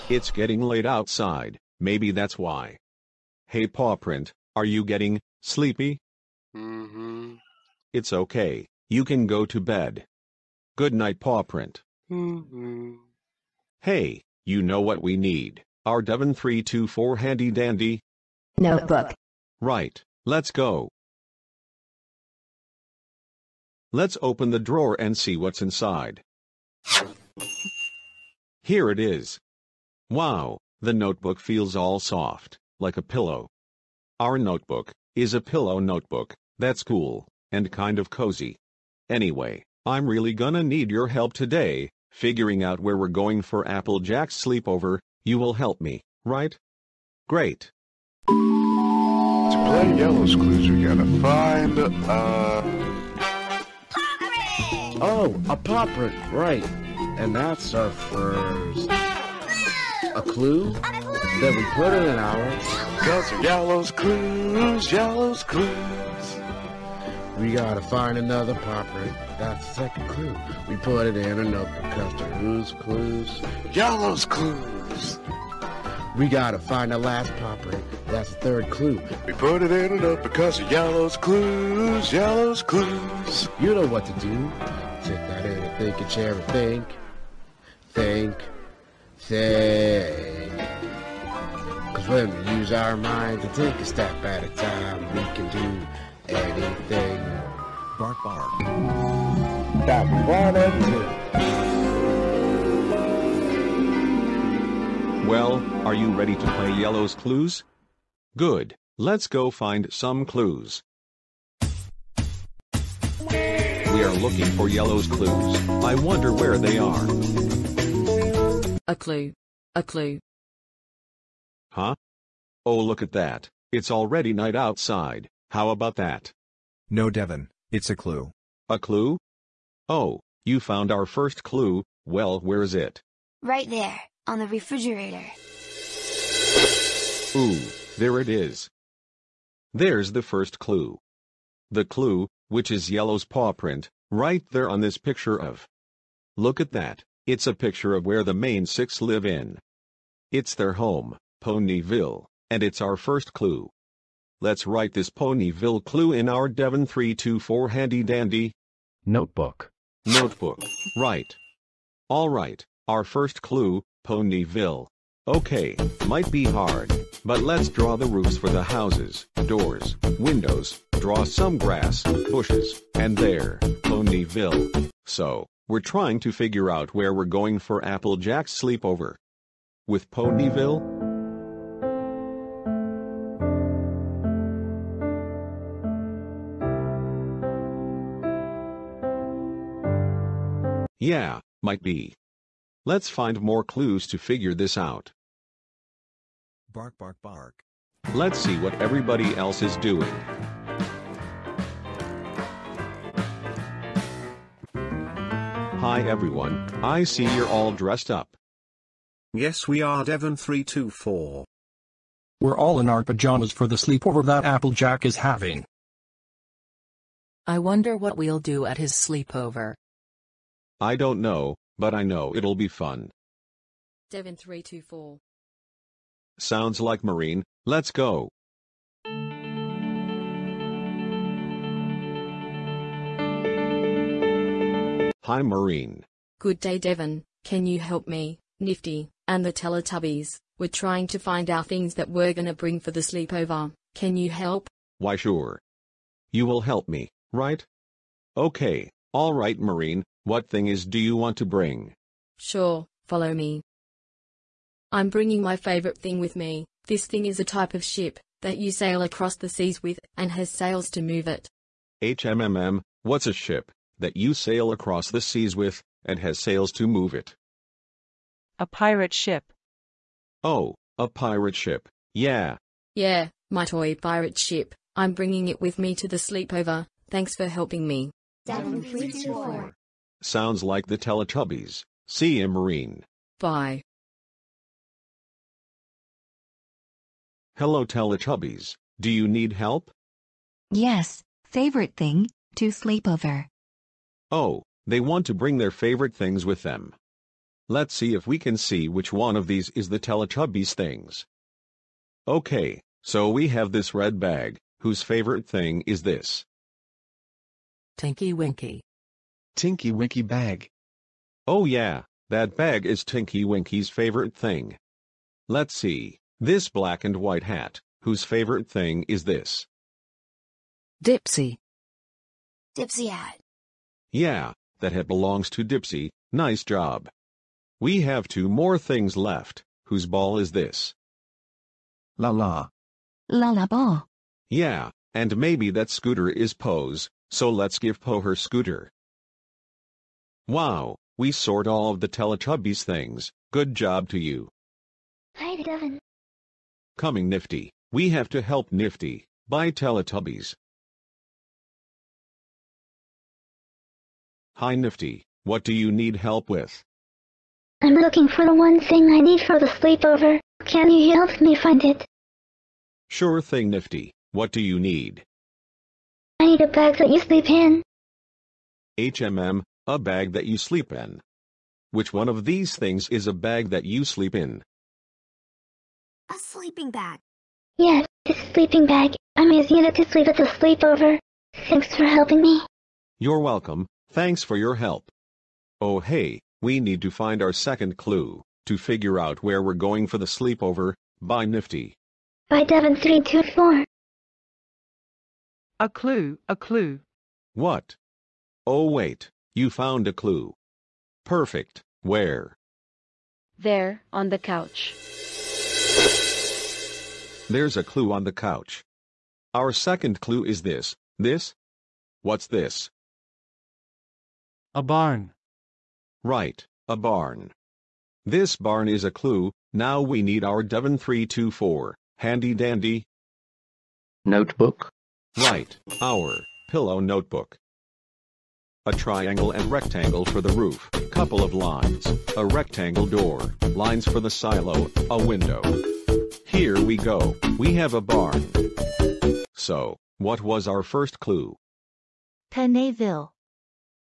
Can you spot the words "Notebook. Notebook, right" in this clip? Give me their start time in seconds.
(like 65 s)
159 s.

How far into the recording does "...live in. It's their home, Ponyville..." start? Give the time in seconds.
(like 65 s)
149 s.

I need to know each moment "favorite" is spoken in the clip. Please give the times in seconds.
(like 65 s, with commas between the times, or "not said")
255 s, 291 s, 295 s, 305 s, 313 s, 318 s.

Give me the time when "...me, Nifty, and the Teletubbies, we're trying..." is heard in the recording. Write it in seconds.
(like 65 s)
238 s.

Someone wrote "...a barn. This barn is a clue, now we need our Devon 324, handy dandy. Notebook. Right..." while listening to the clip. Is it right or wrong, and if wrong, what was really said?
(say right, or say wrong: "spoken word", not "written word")
right.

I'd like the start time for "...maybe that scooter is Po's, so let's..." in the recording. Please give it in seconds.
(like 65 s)
335 s.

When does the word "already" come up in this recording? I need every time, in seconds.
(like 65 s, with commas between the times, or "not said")
123 s.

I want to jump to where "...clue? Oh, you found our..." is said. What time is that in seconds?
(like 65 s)
128 s.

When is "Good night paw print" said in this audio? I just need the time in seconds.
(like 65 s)
10 s.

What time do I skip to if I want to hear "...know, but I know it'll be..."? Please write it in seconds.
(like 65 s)
221 s.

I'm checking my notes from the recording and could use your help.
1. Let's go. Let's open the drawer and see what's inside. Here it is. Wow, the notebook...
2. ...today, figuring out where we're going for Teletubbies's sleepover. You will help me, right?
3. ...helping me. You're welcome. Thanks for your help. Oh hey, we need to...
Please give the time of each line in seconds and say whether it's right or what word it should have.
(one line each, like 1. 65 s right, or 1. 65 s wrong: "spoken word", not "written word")
1. 20 s right
2. 41 s wrong: "Applejack", not "Teletubbies"
3. 382 s right.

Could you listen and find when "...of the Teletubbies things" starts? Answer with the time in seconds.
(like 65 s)
341 s.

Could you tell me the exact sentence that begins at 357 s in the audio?
I'm looking for the one thing I need for the sleepover.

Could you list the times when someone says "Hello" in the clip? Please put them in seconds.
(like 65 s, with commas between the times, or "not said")
287 s.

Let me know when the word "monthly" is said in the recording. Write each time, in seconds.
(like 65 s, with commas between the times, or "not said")
not said.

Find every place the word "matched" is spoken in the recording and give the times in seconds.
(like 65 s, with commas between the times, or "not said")
not said.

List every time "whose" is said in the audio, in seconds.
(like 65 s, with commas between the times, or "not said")
304 s, 318 s, 329 s.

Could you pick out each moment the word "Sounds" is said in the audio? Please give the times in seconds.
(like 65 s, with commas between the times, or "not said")
226 s, 280 s.